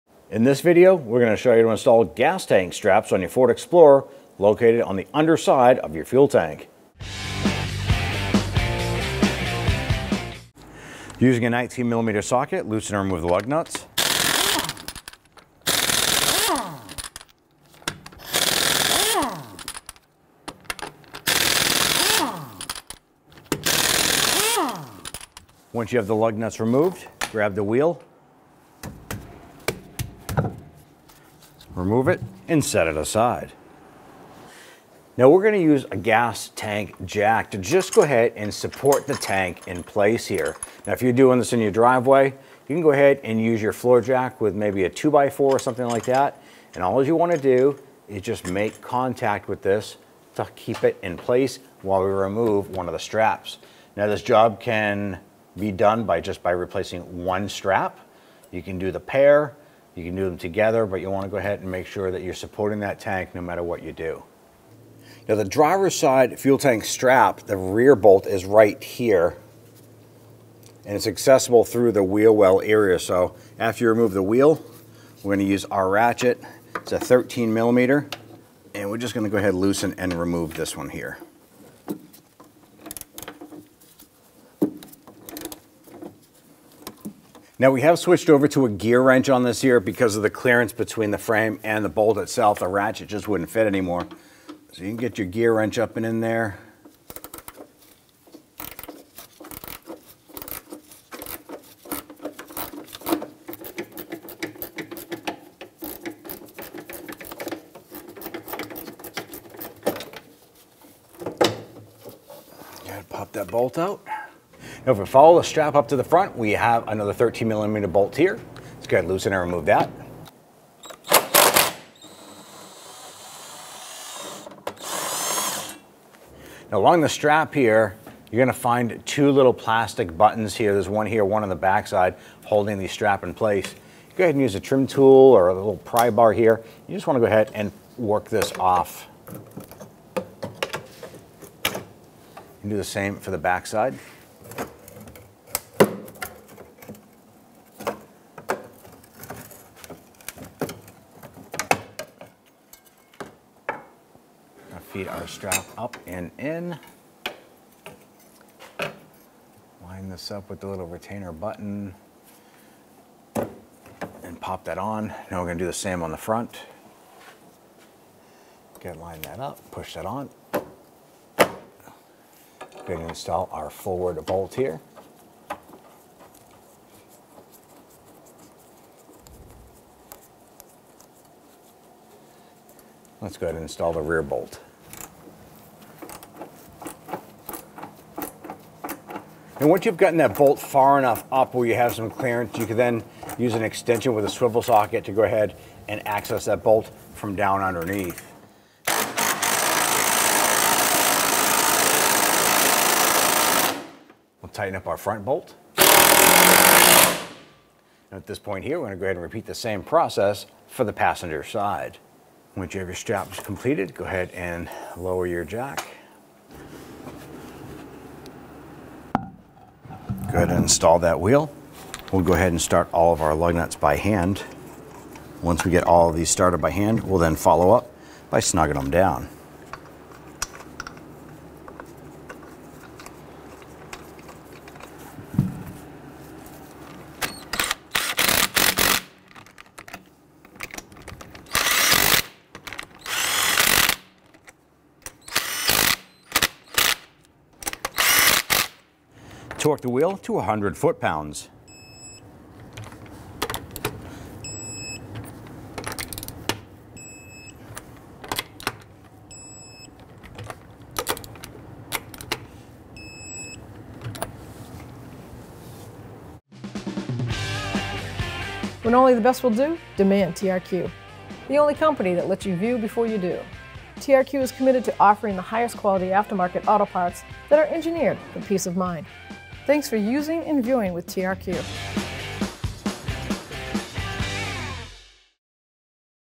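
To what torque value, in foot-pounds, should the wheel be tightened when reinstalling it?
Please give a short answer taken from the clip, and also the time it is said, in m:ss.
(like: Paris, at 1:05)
100, at 4:10.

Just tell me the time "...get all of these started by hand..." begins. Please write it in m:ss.
3:45.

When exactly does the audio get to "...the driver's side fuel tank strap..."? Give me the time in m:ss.
1:05.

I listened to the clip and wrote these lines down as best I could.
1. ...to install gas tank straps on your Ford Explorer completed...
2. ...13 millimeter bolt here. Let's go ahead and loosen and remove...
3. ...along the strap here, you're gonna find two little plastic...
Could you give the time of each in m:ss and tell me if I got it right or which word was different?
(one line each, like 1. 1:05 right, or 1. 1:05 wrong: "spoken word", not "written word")
1. 0:01 wrong: "located", not "completed"
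2. 1:57 right
3. 2:06 right.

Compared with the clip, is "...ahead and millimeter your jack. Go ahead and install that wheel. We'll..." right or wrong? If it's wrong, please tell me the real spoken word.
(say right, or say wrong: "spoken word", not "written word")
wrong: "lower", not "millimeter".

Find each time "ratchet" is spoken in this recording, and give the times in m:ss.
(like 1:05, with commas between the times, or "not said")
1:15, 1:32.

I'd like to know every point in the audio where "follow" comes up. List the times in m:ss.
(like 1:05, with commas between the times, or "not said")
1:55, 3:47.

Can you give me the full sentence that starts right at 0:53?
Now this job can be done by just by replacing one strap.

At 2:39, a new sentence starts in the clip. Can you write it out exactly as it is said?
Line this up with the little retainer button and pop that on.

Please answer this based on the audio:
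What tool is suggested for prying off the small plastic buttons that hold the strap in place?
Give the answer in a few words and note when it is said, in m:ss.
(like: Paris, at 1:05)
trim tool, at 2:14.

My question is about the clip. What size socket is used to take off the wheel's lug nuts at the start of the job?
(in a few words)
19 millimeter.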